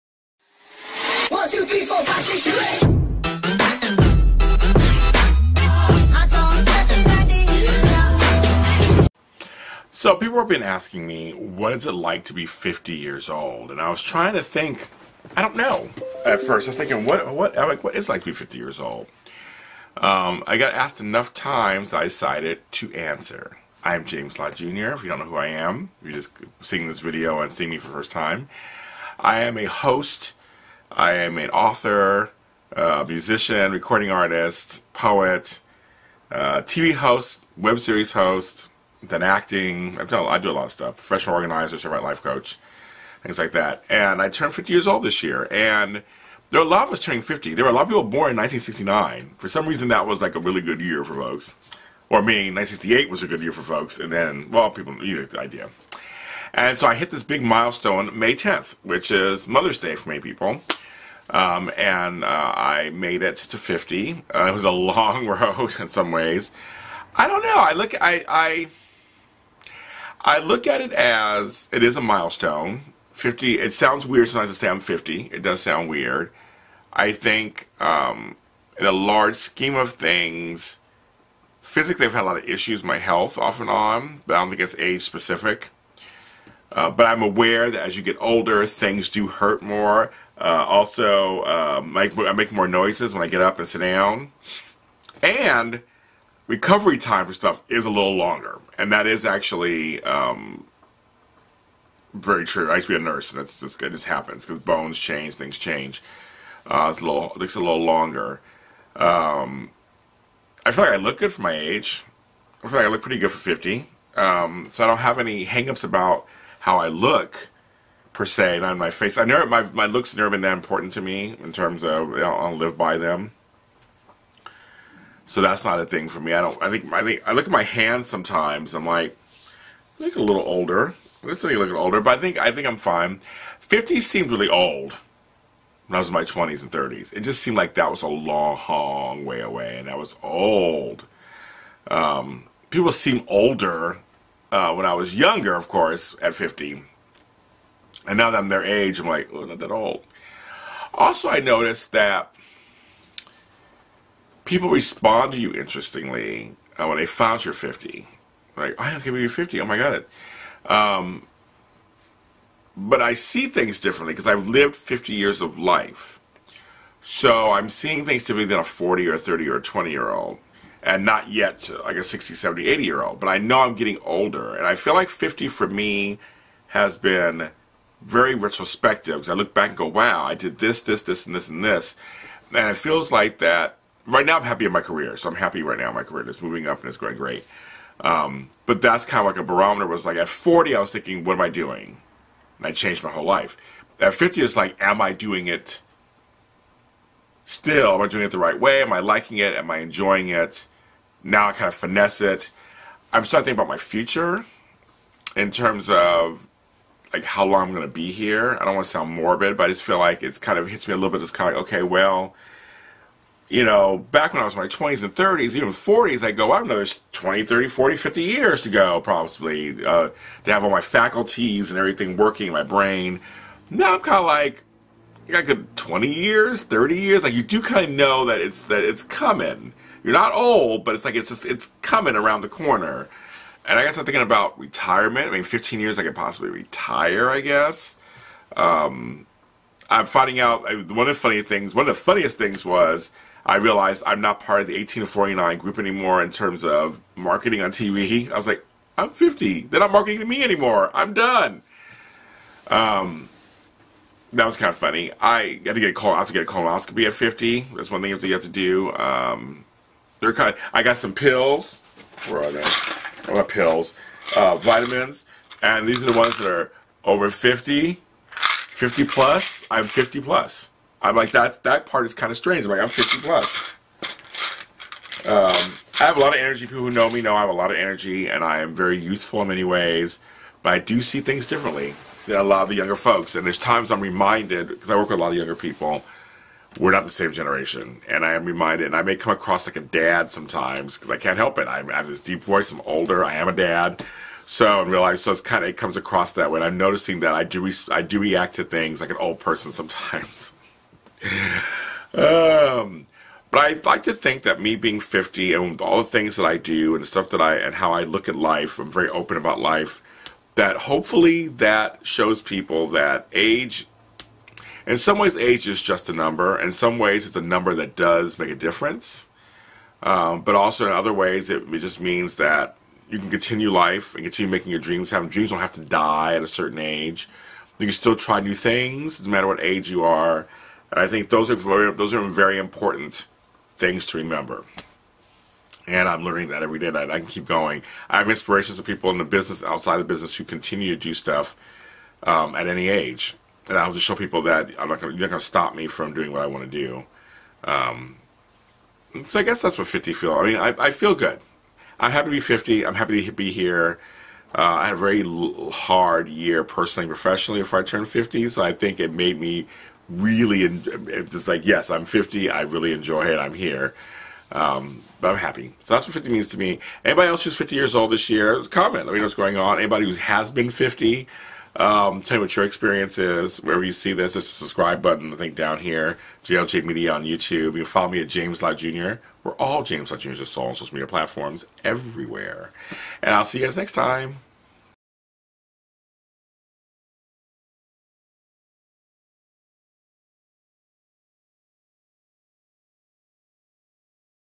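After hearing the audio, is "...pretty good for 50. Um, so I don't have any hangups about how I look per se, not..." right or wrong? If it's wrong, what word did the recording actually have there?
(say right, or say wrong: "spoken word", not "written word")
right.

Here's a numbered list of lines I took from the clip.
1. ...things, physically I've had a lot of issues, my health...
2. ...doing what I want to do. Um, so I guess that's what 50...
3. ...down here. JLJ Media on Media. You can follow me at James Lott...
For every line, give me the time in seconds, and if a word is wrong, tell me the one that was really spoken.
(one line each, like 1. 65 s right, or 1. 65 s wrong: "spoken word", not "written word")
1. 79 s right
2. 346 s right
3. 375 s wrong: "YouTube", not "Media".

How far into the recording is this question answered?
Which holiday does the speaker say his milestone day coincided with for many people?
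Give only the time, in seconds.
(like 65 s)
59 s.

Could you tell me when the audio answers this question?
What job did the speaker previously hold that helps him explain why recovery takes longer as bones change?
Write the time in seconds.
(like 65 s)
102 s.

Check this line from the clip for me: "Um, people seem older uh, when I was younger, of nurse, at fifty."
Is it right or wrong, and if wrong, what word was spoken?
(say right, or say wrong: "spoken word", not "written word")
wrong: "course", not "nurse".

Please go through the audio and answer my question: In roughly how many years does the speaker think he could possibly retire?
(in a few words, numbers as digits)
15 years.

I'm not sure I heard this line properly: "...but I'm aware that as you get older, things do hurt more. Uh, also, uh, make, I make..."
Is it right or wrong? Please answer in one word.
right.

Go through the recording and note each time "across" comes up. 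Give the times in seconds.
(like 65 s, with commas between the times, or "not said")
289 s, 295 s.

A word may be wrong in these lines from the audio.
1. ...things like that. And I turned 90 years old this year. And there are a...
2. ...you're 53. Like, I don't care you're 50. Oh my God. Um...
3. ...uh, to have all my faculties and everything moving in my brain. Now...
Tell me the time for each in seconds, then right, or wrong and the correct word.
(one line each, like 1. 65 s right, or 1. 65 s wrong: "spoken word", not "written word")
1. 43 s wrong: "50", not "90"
2. 157 s wrong: "50", not "53"
3. 219 s wrong: "working", not "moving".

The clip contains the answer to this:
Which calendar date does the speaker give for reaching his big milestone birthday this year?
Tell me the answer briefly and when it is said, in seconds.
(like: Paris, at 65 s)
May 10th, at 58 s.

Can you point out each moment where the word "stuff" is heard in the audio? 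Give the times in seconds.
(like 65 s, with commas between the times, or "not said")
40 s, 97 s, 307 s, 341 s.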